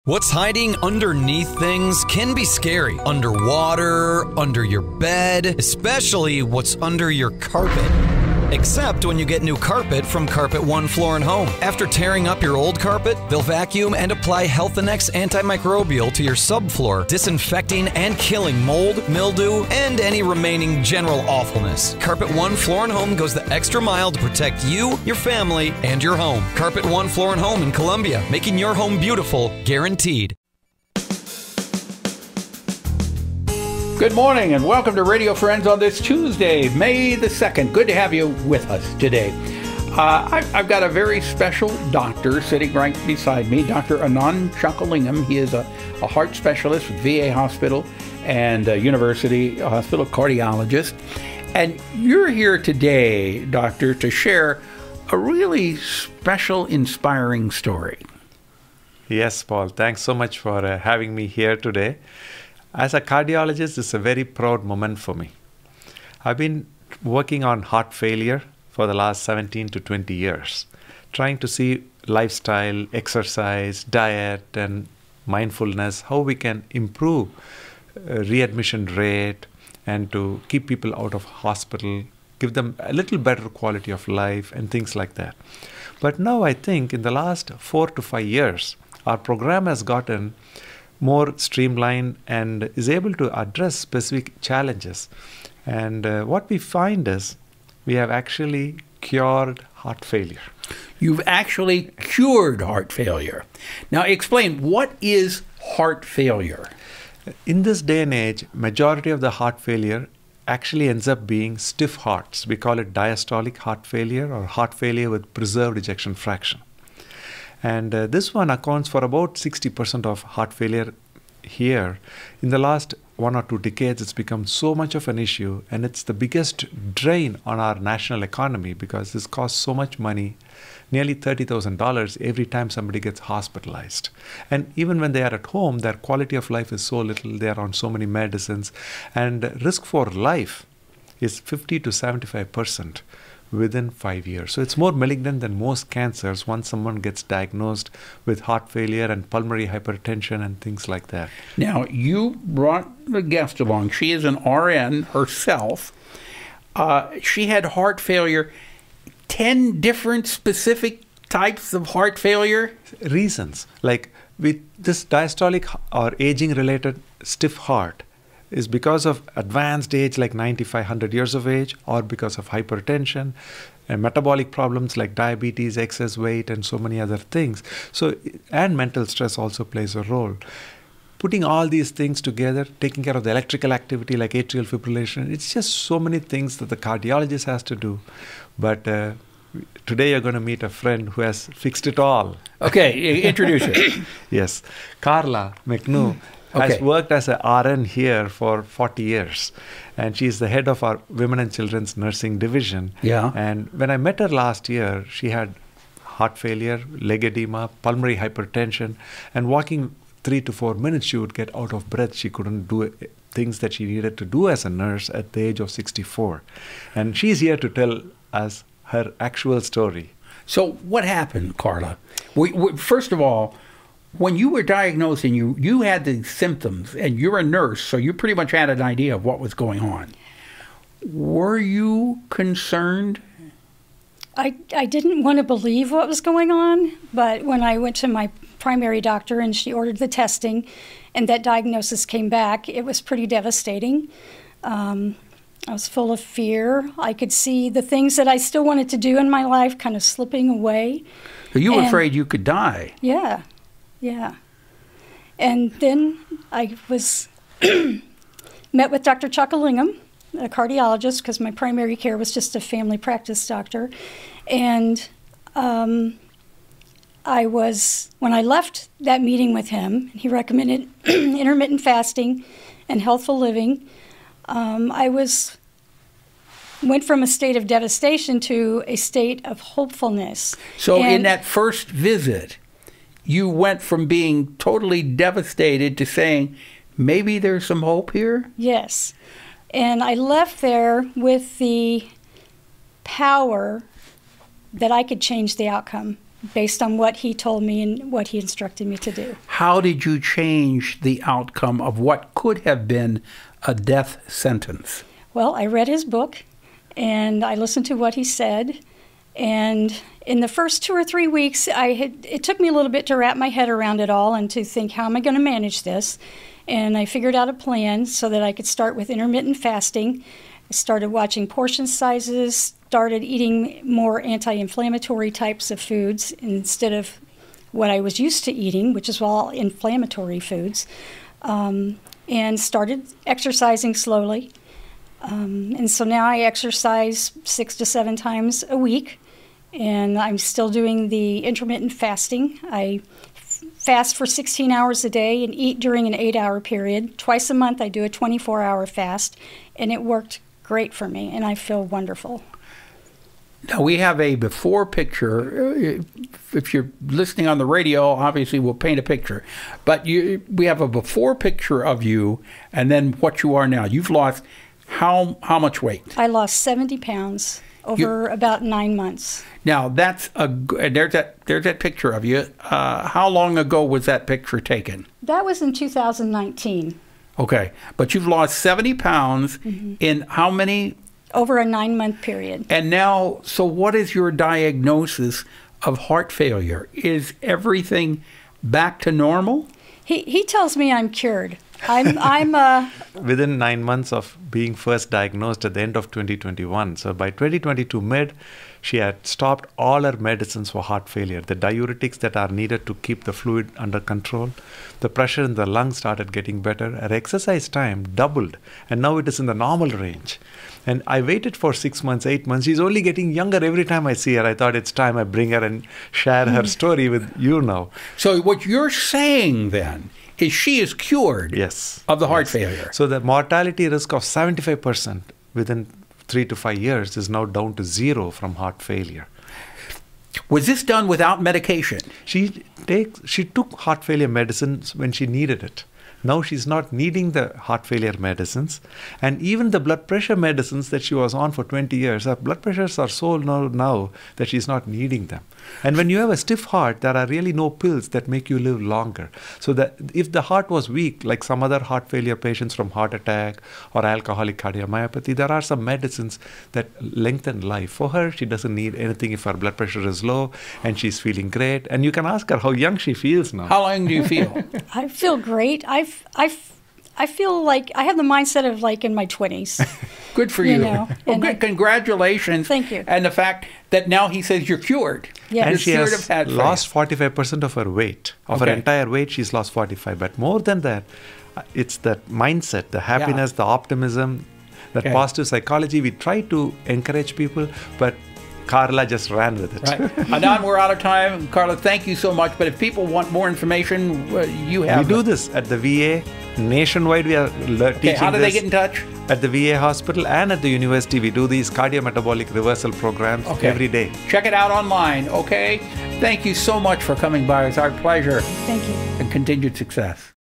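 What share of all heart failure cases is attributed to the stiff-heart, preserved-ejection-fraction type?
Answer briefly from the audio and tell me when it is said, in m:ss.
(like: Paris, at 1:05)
60%, at 1:59.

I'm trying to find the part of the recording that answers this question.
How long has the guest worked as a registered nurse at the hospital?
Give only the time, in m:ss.
3:18.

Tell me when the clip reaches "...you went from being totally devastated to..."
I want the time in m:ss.
4:43.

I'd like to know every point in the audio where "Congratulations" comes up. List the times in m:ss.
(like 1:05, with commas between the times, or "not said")
7:51.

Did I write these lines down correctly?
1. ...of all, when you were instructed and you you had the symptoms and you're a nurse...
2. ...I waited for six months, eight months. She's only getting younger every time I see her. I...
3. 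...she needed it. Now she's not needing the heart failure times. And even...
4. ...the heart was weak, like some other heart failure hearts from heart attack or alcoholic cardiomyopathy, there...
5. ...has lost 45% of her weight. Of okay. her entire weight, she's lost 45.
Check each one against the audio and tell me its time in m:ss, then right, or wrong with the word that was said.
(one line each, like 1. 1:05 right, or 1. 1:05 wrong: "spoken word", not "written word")
1. 3:43 wrong: "diagnosed", not "instructed"
2. 6:51 right
3. 7:15 wrong: "medicines", not "times"
4. 7:30 wrong: "patients", not "hearts"
5. 7:55 right.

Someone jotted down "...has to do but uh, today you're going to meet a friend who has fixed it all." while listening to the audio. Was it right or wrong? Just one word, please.
right.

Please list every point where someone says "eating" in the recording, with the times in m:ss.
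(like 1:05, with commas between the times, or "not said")
5:23, 5:28.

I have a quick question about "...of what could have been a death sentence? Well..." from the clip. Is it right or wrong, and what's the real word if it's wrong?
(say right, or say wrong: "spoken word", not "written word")
right.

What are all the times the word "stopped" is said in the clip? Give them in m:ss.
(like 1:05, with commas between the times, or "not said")
6:39.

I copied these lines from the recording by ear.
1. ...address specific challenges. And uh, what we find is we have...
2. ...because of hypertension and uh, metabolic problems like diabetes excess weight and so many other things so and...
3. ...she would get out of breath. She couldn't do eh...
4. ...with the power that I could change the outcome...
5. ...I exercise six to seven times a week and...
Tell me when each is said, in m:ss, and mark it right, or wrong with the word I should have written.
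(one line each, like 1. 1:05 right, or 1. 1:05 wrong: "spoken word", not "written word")
1. 1:33 right
2. 2:52 right
3. 3:31 right
4. 4:51 right
5. 5:36 right.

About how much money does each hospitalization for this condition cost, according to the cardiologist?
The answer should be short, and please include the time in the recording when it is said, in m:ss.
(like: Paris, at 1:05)
$30,000, at 2:11.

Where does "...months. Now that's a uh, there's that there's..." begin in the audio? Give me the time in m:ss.
6:08.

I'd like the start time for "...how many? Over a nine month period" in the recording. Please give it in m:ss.
6:20.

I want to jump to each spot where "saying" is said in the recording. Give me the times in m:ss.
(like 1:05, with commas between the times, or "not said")
4:46, 6:58.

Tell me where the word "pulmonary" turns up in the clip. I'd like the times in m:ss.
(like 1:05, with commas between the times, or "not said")
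2:29, 3:27.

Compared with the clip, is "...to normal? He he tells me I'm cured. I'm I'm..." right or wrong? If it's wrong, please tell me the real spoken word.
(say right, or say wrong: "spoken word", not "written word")
right.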